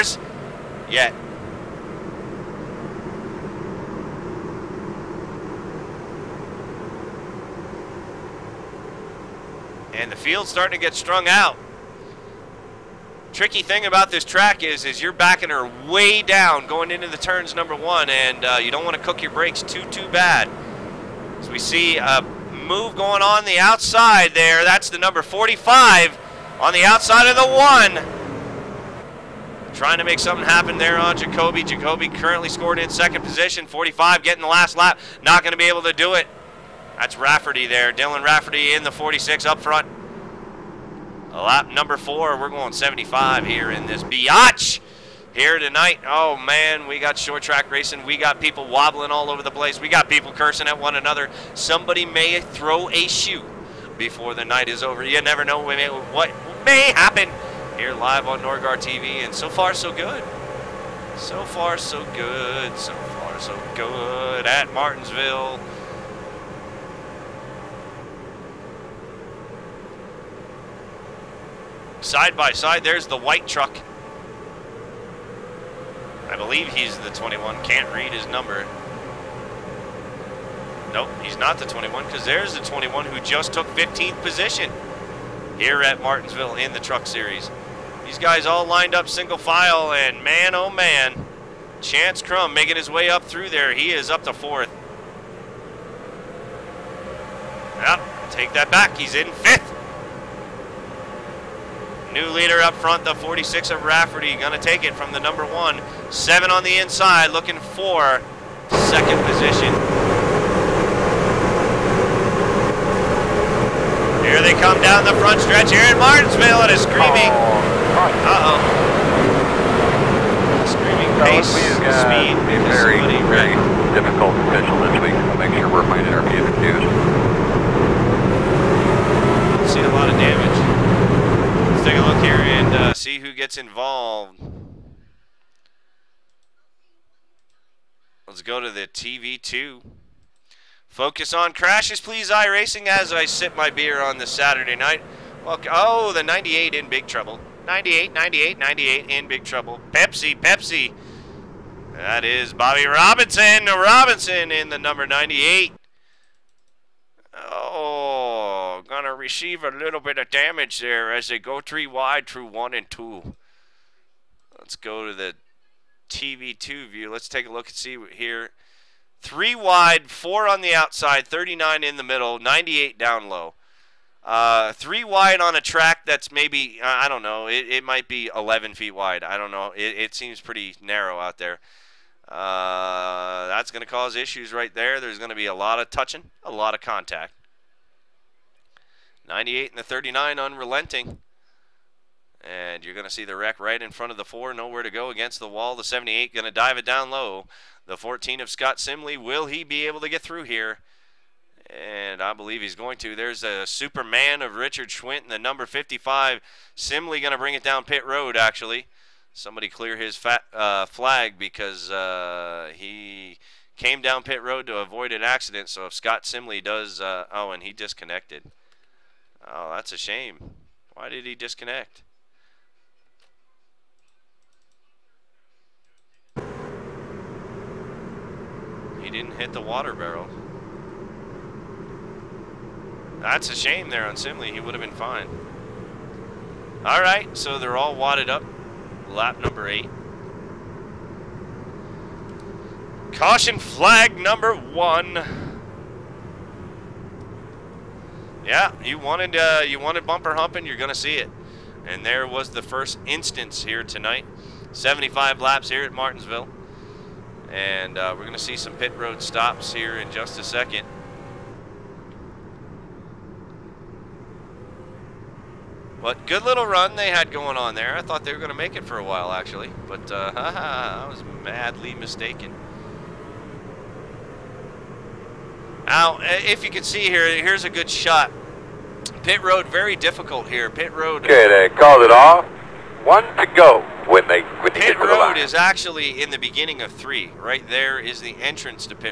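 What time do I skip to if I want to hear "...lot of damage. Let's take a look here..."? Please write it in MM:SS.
02:09.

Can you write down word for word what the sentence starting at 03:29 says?
Somebody clear his fat, uh, flag because uh, he came down pit road to avoid an accident.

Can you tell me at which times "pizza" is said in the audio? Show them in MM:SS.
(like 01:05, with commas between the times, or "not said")
not said.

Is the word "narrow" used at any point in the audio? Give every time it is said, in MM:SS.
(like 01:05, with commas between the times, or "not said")
03:00.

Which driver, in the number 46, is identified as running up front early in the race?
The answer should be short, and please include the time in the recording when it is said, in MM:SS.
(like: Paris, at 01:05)
Dylan Rafferty, at 00:37.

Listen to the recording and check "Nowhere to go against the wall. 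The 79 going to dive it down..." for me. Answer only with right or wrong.
wrong.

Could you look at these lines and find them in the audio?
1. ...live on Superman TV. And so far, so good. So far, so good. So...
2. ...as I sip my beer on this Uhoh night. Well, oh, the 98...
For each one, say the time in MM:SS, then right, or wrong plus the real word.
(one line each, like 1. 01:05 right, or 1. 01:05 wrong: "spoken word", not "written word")
1. 00:57 wrong: "Nordgar", not "Superman"
2. 02:22 wrong: "Saturday", not "Uhoh".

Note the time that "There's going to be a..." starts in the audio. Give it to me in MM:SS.
03:04.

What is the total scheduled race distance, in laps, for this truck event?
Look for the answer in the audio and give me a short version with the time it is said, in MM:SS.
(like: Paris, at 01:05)
75, at 04:14.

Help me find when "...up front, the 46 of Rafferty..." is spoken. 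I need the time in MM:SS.
01:42.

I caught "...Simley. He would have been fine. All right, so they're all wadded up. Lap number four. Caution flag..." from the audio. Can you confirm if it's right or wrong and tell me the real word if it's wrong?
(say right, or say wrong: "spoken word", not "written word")
wrong: "eight", not "four".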